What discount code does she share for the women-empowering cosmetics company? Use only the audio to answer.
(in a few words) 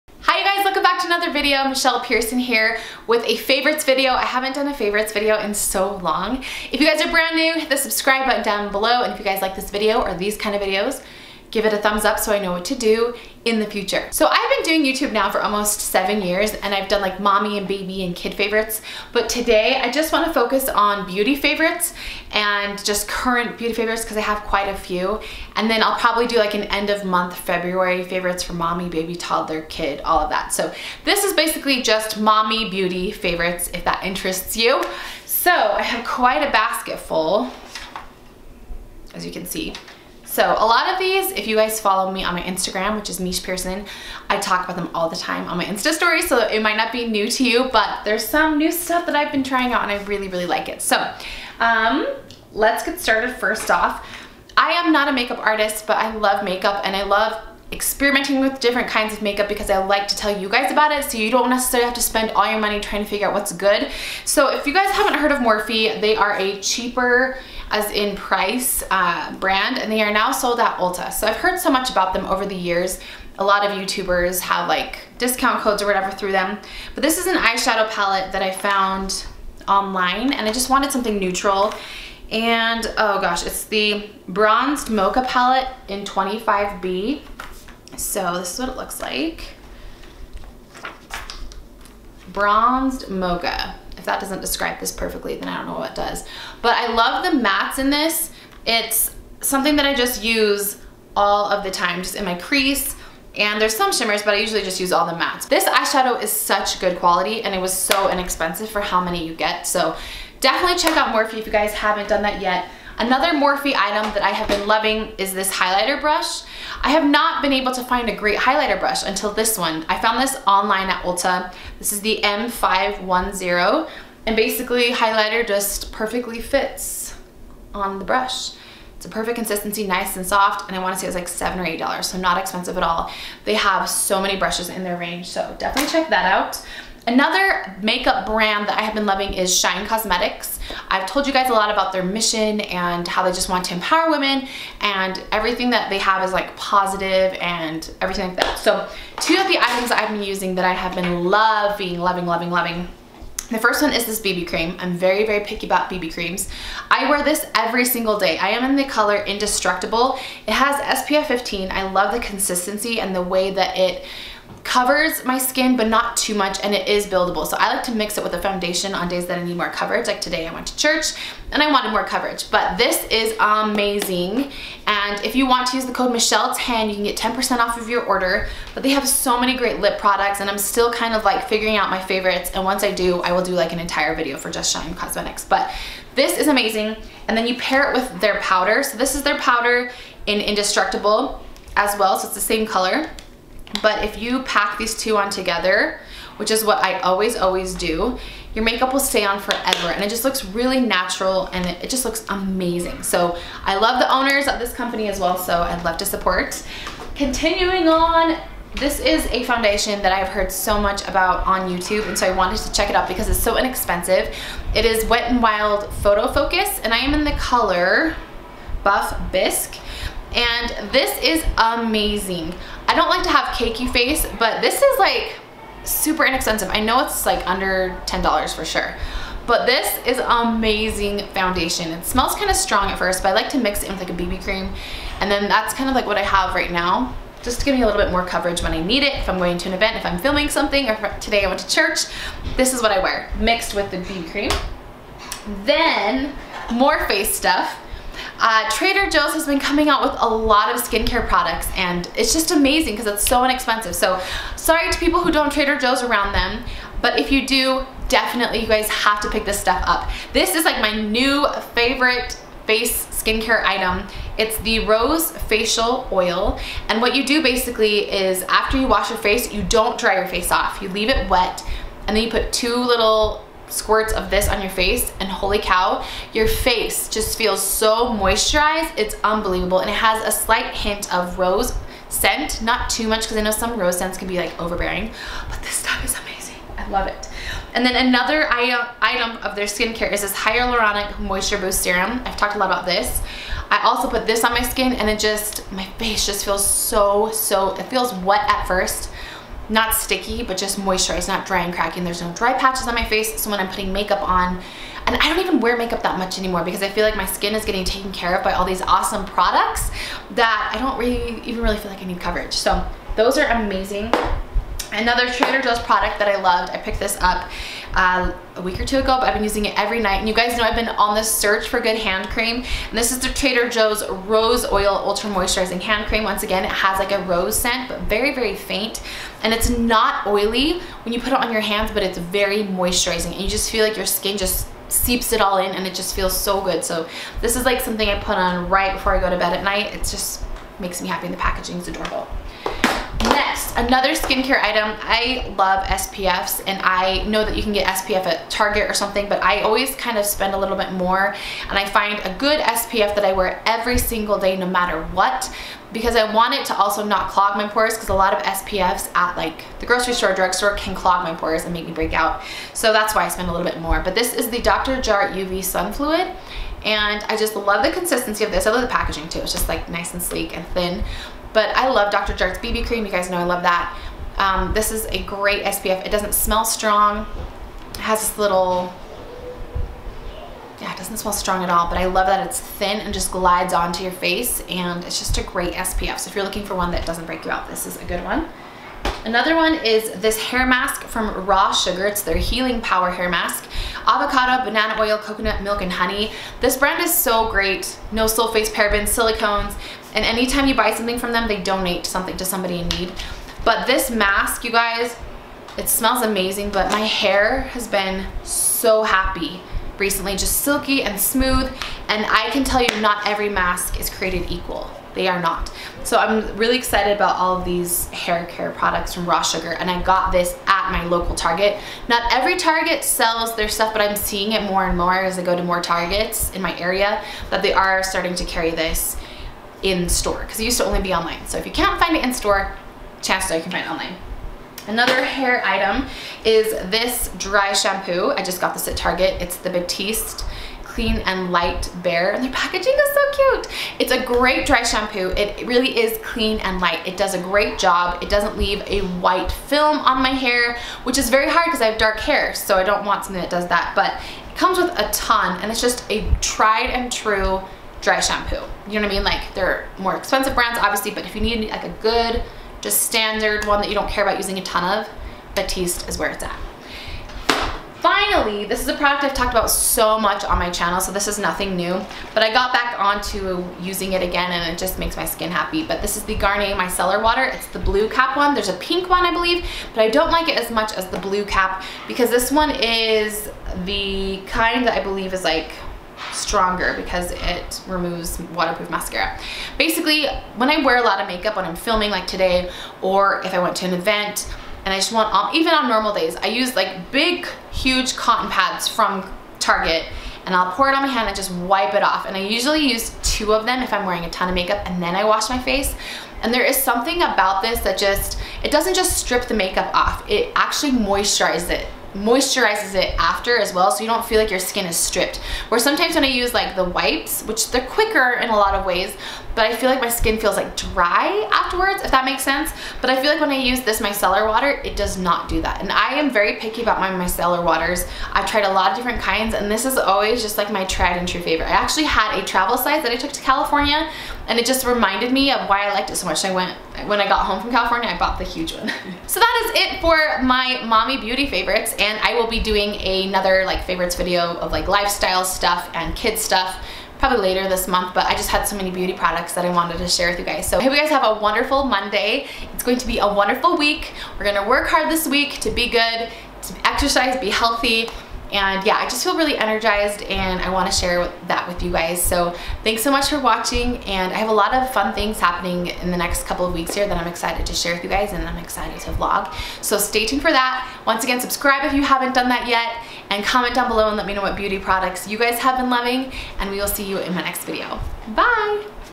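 Michelle10.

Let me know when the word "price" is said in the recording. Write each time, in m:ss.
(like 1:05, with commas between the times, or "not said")
1:08.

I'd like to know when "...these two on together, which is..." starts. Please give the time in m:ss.
3:14.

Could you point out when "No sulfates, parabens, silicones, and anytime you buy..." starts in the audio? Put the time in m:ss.
6:38.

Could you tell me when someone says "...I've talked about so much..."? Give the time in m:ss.
7:49.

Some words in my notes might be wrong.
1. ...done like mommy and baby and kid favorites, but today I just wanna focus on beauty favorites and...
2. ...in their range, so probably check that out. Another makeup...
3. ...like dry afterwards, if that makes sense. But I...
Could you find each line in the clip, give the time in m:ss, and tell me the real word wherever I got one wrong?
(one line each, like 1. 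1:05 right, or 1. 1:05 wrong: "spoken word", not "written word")
1. 0:16 right
2. 2:14 wrong: "definitely", not "probably"
3. 8:40 right.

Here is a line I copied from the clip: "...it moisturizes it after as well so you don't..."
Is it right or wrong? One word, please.
right.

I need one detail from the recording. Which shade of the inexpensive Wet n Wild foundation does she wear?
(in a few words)
Buff Bisque.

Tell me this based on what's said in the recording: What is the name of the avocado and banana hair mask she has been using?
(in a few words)
Healing Power.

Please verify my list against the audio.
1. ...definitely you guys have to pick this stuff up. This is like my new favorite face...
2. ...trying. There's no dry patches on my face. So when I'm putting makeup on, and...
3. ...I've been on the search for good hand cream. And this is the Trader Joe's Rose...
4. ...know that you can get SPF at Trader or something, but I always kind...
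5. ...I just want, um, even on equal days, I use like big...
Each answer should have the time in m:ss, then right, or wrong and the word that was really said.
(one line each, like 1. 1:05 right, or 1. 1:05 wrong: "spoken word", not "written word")
1. 4:18 right
2. 5:01 wrong: "cracking", not "trying"
3. 5:20 right
4. 5:47 wrong: "Target", not "Trader"
5. 8:14 wrong: "normal", not "equal".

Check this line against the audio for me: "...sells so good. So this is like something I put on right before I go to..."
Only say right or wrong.
wrong.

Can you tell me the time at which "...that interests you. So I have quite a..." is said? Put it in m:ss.
0:33.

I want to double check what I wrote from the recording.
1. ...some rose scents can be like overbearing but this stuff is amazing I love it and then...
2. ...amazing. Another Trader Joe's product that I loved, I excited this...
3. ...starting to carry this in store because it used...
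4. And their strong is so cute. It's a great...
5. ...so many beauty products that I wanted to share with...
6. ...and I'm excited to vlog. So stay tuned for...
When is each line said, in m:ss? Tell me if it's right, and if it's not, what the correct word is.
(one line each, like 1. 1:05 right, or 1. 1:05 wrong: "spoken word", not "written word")
1. 4:43 right
2. 5:13 wrong: "picked", not "excited"
3. 7:08 right
4. 7:22 wrong: "packaging", not "strong"
5. 9:08 right
6. 9:28 right.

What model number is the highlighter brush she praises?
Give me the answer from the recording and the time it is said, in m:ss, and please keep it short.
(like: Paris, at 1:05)
M510, at 2:02.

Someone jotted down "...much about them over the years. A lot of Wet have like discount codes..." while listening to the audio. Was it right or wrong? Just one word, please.
wrong.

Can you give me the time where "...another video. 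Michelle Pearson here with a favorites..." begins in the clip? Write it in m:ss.
0:01.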